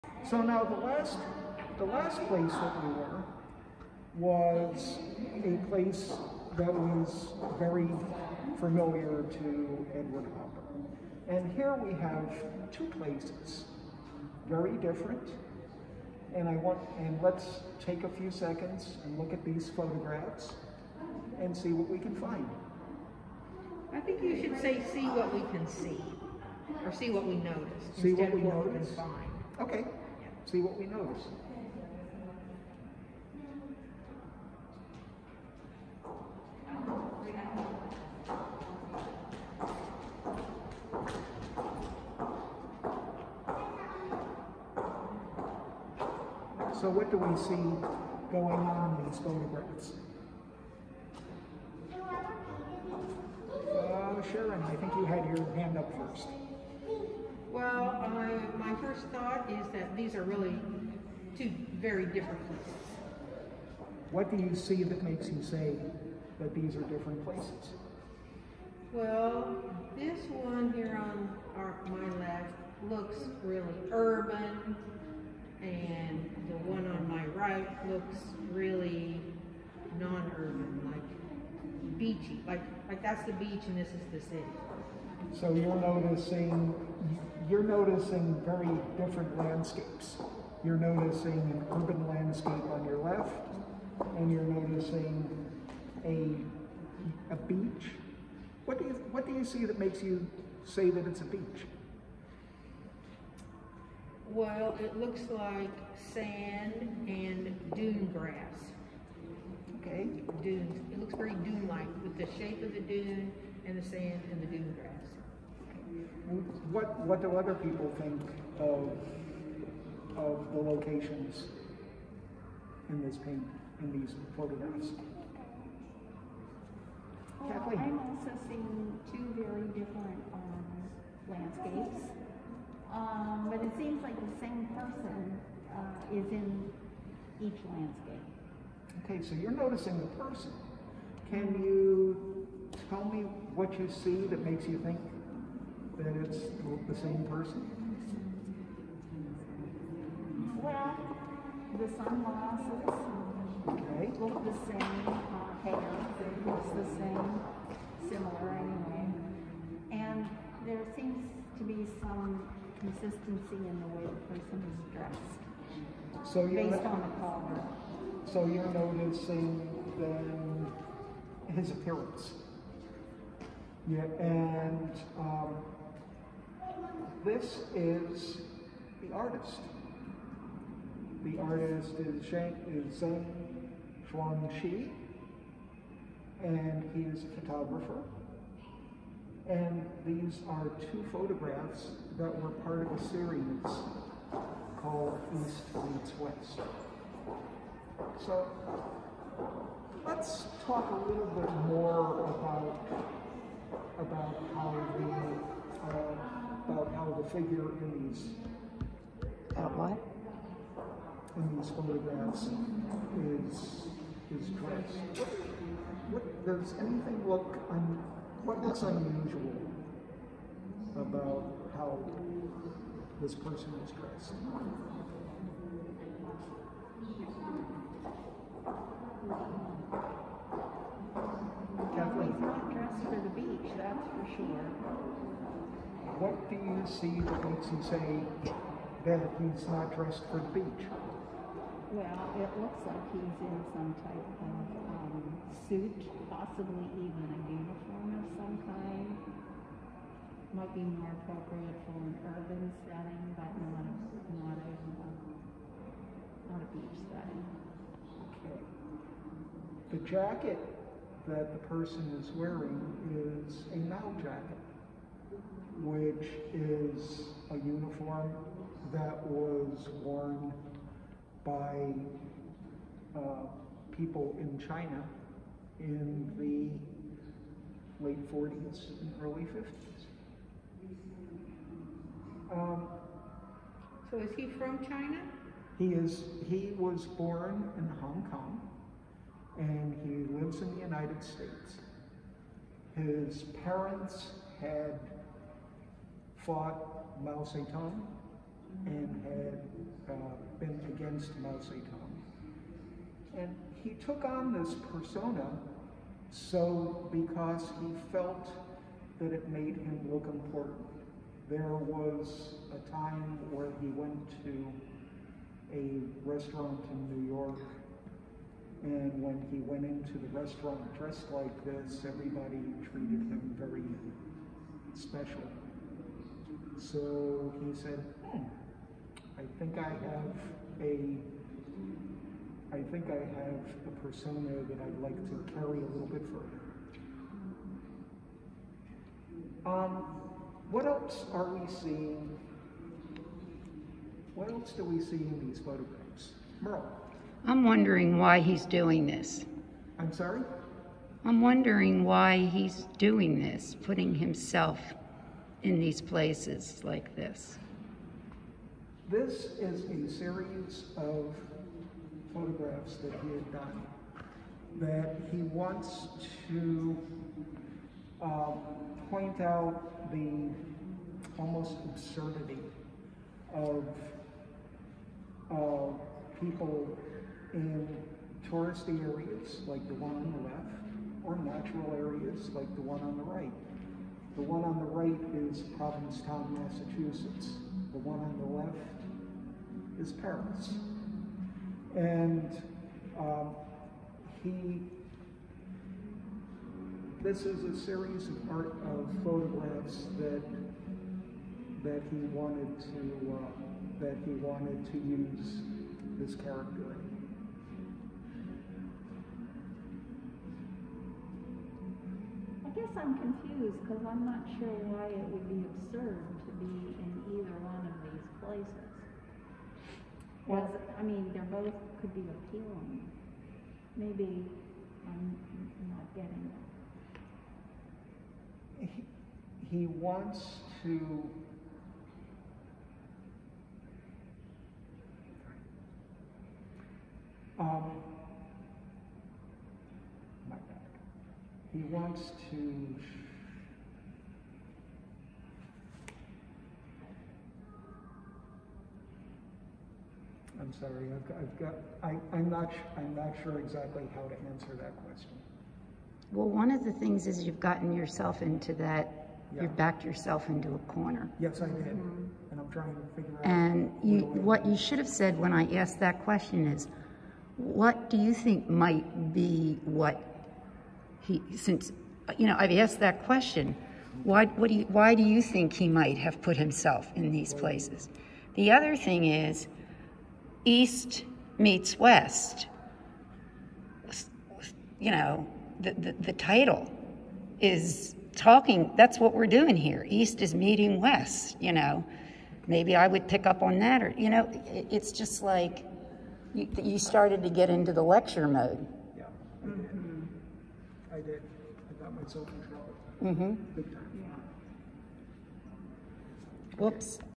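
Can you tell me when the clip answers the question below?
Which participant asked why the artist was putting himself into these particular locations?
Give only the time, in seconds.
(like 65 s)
346 s.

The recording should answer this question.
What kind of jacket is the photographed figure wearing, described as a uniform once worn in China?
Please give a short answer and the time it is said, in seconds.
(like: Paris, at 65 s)
Mao jacket, at 263 s.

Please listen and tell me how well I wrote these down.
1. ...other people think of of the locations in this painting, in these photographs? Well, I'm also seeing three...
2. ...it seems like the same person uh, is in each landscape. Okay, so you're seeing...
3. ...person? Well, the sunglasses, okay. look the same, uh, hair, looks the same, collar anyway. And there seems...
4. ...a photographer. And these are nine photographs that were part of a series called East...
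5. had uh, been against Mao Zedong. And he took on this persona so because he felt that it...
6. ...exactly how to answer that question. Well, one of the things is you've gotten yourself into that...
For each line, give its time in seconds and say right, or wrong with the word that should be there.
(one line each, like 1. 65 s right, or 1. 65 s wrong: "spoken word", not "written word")
1. 117 s wrong: "two", not "three"
2. 133 s wrong: "noticing", not "seeing"
3. 147 s wrong: "similar", not "collar"
4. 187 s wrong: "two", not "nine"
5. 299 s right
6. 453 s right.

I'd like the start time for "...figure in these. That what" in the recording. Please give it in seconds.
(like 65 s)
207 s.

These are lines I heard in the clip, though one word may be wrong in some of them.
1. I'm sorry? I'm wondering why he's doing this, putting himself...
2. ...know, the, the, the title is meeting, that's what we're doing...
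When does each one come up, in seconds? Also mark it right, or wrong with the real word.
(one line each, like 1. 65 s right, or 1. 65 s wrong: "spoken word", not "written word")
1. 349 s right
2. 485 s wrong: "talking", not "meeting".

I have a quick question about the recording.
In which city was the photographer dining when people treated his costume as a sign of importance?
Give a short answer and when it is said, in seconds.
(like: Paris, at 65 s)
New York, at 317 s.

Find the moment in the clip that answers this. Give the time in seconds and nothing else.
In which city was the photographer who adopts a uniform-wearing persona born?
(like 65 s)
288 s.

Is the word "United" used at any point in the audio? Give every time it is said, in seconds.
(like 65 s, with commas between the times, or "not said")
290 s.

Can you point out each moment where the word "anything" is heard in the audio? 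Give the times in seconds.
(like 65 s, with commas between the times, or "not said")
216 s.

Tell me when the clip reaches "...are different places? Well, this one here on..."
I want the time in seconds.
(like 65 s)
66 s.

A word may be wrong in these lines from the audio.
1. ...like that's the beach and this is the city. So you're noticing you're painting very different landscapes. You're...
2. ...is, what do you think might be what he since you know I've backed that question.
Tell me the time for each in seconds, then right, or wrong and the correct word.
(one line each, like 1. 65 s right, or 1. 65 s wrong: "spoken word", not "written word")
1. 82 s wrong: "noticing", not "painting"
2. 466 s wrong: "asked", not "backed".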